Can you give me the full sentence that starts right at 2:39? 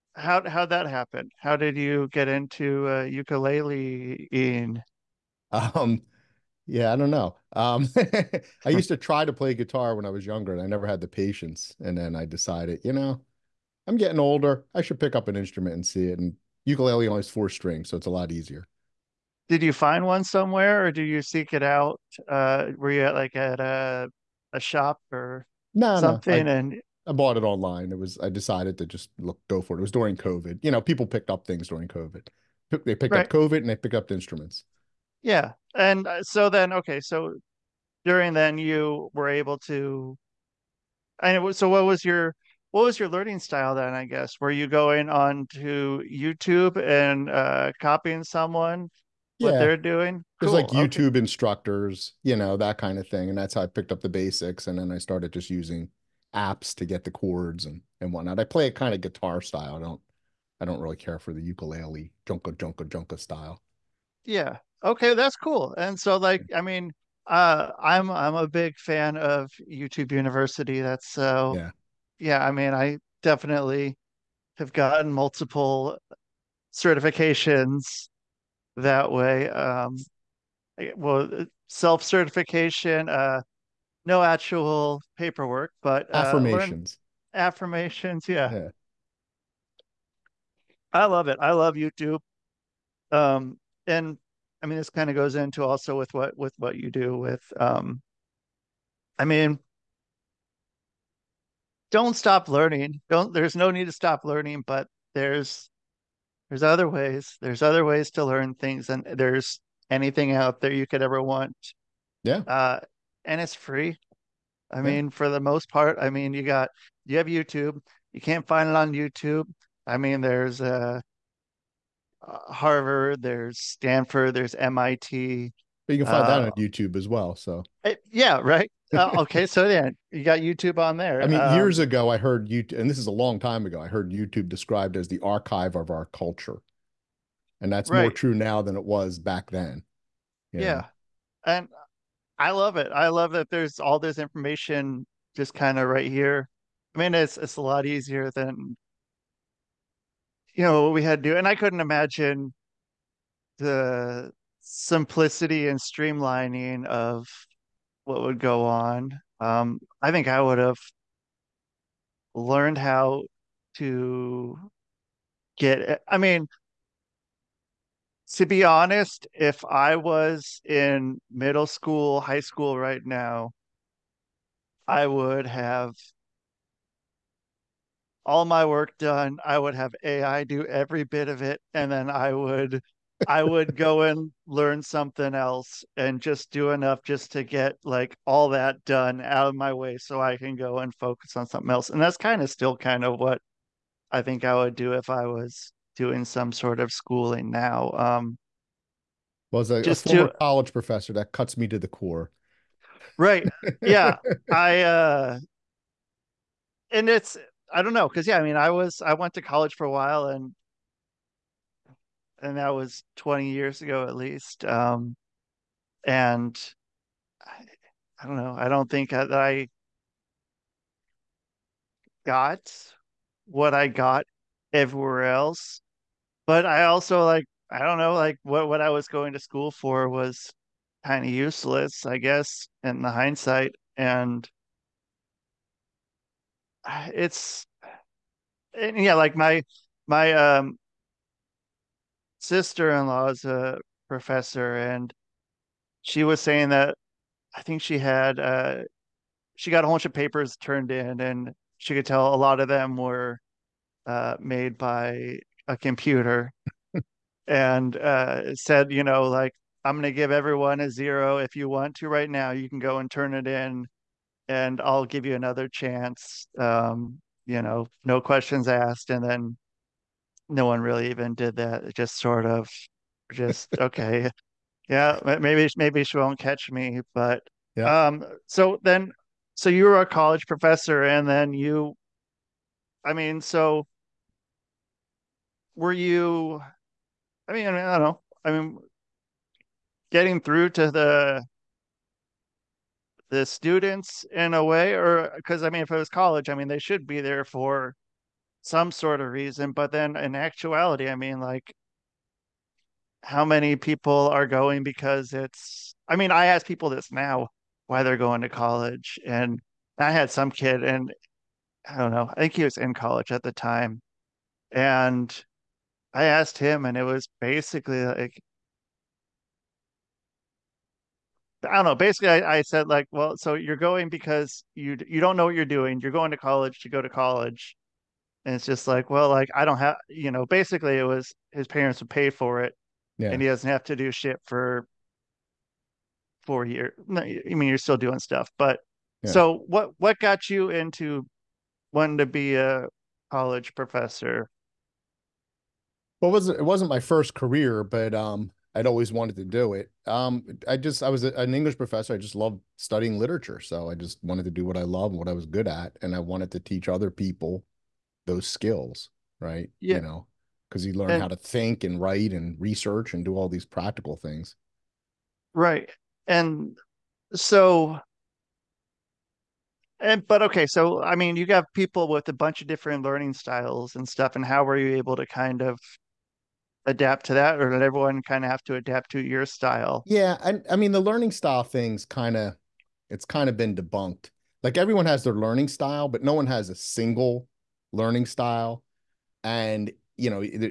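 Um, I think I would have learned how to get.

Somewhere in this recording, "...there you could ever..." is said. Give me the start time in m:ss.
1:50.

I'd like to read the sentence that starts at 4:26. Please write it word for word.
Um, you know, no questions asked.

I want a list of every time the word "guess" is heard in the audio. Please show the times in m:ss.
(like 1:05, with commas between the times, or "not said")
0:44, 3:52.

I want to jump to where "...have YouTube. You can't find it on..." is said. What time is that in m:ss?
1:57.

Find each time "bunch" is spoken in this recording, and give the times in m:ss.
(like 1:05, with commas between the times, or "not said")
4:09, 6:12.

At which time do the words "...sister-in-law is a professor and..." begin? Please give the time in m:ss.
4:02.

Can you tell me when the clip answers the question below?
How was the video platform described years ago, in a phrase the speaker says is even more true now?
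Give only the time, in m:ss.
2:15.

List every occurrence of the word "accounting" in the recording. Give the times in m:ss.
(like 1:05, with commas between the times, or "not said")
not said.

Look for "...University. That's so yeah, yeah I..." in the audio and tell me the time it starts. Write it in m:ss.
1:10.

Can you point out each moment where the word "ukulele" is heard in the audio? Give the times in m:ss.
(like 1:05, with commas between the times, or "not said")
0:03, 0:16, 1:01.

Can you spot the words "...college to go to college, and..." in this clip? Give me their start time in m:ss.
5:26.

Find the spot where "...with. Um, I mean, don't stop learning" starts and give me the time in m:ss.
1:37.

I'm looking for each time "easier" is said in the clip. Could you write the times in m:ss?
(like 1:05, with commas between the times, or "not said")
0:18, 2:27.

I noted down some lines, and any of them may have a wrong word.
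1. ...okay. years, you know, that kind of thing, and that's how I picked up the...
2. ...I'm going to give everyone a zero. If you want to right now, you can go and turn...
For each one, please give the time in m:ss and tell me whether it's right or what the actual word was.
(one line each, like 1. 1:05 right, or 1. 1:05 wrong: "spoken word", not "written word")
1. 0:51 wrong: "instructors", not "years"
2. 4:19 right.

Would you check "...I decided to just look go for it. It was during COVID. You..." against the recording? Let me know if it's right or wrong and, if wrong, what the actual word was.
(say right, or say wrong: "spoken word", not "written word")
right.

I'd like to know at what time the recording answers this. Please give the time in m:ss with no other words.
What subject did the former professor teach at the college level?
5:51.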